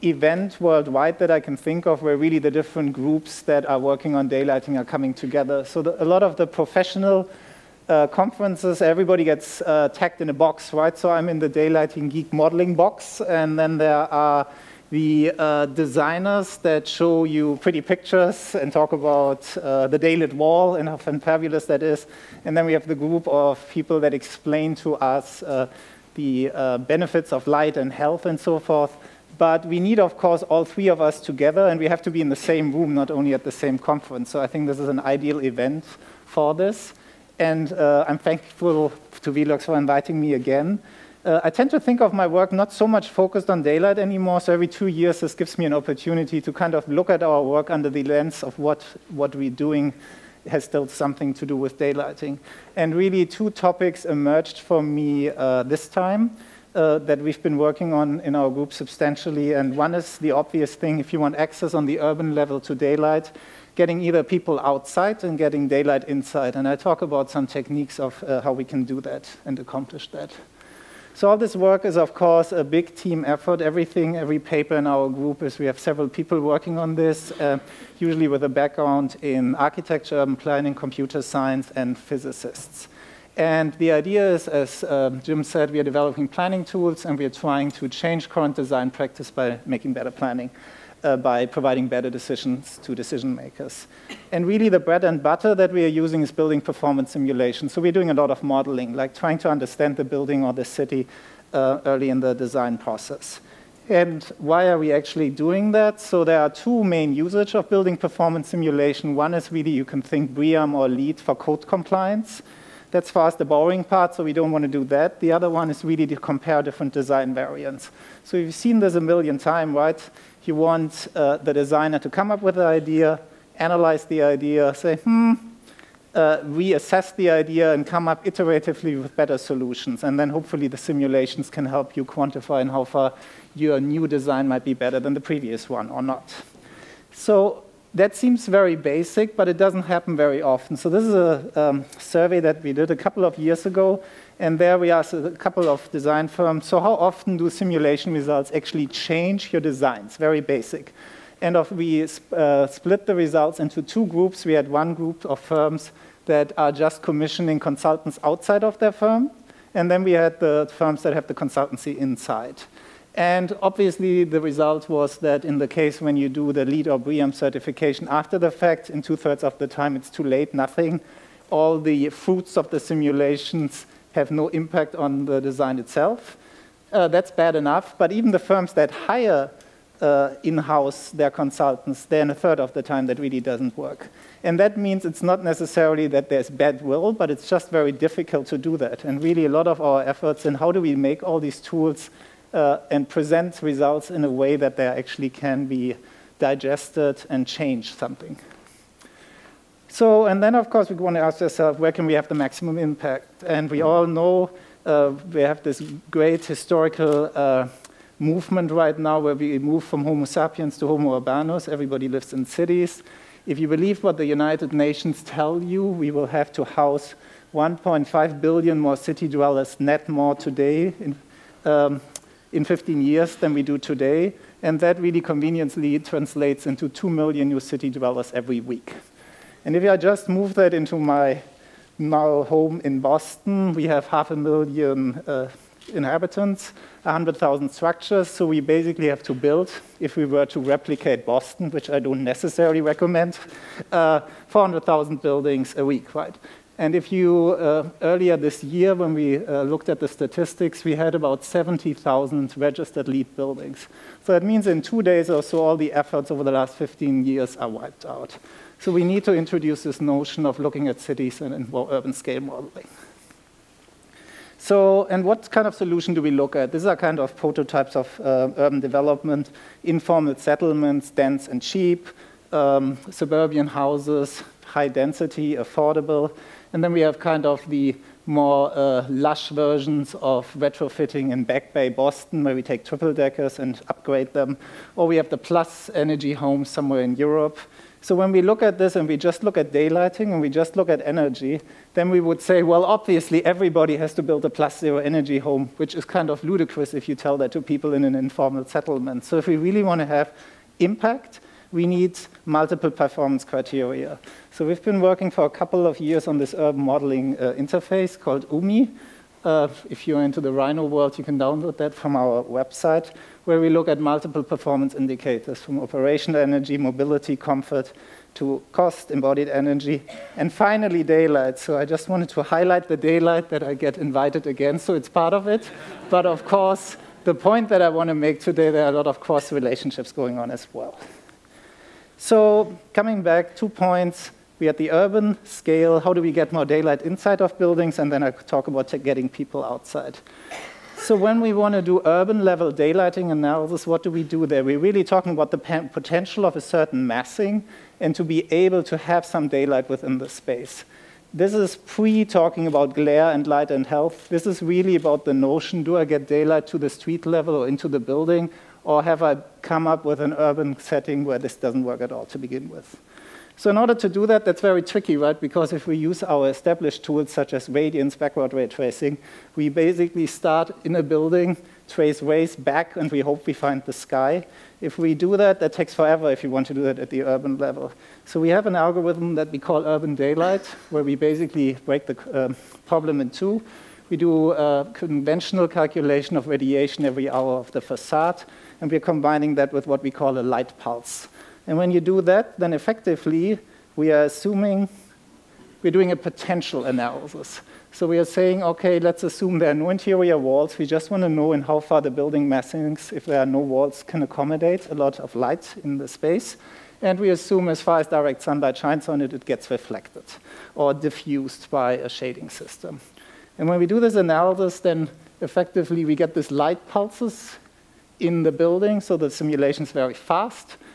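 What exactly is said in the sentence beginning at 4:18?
So we need to introduce this notion of looking at cities and, more urban scale modeling.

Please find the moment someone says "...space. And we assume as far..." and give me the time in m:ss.
6:46.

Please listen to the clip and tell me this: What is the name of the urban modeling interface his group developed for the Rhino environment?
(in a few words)
UMI.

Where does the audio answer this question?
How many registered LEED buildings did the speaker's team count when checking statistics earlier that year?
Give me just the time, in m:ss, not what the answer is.
4:11.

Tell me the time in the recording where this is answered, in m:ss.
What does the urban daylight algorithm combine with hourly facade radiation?
6:30.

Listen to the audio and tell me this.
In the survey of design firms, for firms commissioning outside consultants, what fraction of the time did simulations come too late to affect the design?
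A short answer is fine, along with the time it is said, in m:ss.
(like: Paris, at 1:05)
two thirds, at 2:49.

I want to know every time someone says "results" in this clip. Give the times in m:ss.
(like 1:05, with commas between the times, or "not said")
2:28, 2:33, 2:44, 3:13.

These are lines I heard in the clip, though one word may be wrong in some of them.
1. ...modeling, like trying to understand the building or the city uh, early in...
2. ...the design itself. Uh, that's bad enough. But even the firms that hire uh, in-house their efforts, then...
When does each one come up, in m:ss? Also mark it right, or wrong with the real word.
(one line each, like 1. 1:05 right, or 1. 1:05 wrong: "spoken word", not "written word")
1. 1:38 right
2. 2:55 wrong: "consultants", not "efforts".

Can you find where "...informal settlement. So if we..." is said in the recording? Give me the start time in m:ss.
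4:58.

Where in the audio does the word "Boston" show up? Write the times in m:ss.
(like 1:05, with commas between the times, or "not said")
3:52, 4:01, 4:41.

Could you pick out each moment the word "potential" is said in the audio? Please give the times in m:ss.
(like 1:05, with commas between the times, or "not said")
5:45, 6:36.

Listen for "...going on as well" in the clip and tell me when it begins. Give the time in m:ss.
5:30.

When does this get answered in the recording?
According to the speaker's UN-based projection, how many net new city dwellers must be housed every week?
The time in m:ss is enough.
3:46.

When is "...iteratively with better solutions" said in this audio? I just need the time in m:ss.
2:08.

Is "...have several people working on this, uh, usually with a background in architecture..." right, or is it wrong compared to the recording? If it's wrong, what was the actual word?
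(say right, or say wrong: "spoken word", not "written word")
right.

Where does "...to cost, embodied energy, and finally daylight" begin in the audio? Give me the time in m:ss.
5:18.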